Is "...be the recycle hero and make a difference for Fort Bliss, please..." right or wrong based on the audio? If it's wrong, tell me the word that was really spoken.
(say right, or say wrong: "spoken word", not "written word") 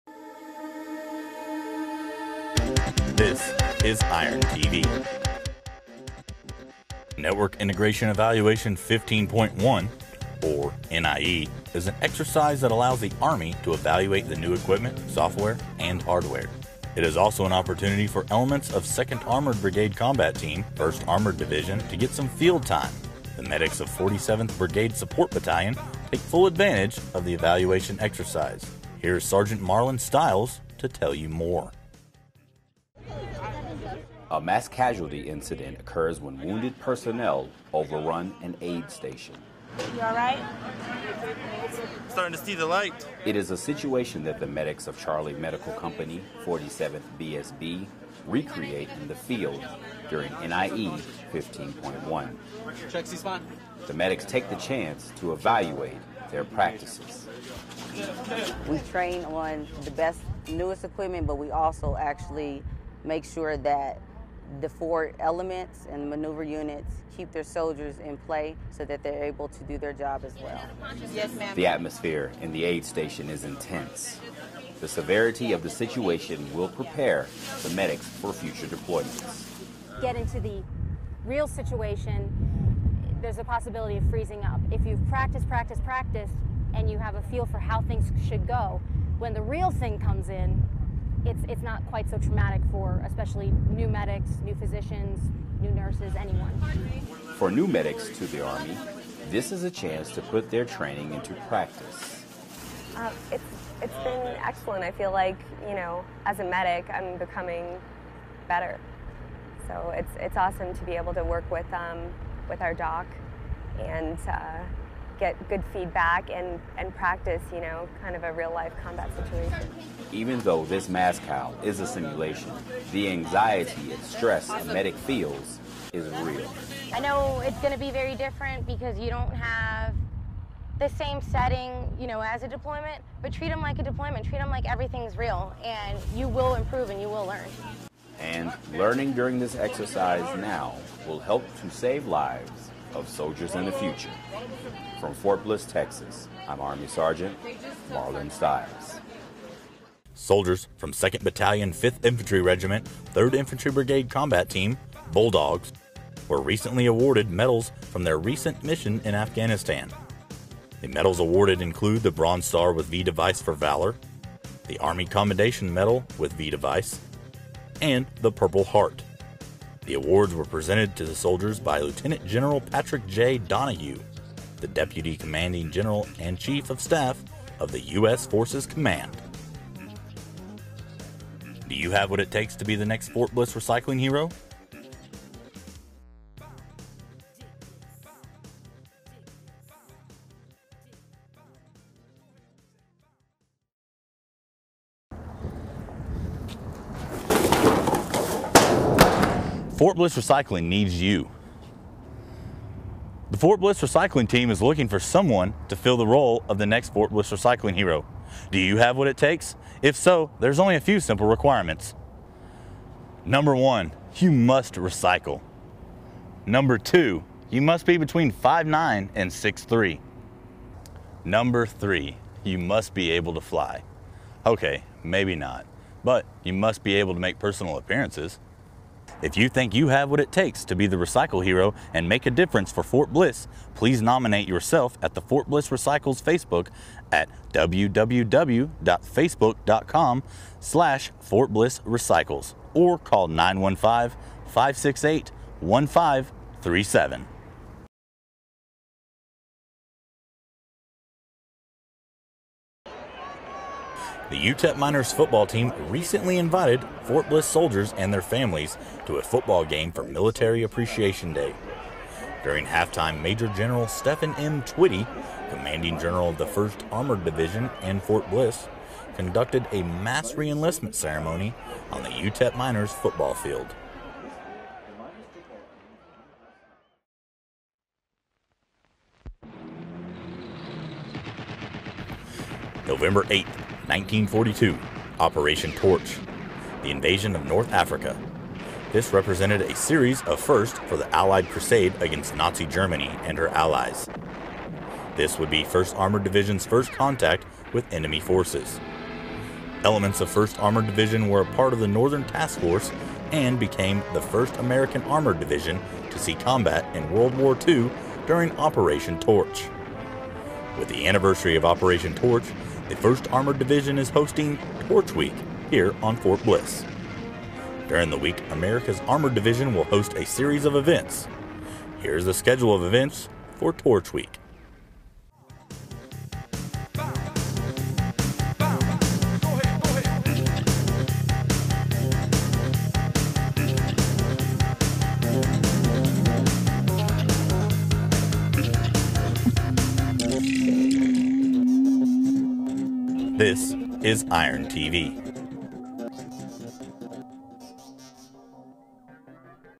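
right.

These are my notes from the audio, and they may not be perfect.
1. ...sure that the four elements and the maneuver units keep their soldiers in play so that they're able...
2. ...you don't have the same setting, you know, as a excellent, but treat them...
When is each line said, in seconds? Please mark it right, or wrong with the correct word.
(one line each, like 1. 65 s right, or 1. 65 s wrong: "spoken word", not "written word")
1. 63 s right
2. 128 s wrong: "deployment", not "excellent".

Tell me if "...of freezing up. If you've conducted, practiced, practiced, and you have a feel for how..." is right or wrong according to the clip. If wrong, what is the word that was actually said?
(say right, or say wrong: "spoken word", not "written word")
wrong: "practiced", not "conducted".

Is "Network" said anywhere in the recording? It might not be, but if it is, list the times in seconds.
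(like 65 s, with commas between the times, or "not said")
7 s.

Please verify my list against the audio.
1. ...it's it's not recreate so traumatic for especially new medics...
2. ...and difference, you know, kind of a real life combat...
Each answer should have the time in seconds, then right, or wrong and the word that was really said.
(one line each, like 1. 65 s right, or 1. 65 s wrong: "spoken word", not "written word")
1. 91 s wrong: "quite", not "recreate"
2. 116 s wrong: "practice", not "difference".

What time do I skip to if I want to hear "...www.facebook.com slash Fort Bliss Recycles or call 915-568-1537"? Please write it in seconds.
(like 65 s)
237 s.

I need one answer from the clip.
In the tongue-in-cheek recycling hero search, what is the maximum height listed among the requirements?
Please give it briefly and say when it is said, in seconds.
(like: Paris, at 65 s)
6'3, at 219 s.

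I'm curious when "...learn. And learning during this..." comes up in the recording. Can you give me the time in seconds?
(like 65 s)
137 s.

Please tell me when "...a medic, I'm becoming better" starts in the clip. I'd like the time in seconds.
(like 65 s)
106 s.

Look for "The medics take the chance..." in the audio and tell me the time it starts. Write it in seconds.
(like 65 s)
53 s.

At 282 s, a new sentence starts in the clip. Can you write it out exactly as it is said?
November 8th, 1942, Operation Torch, the invasion of North Africa.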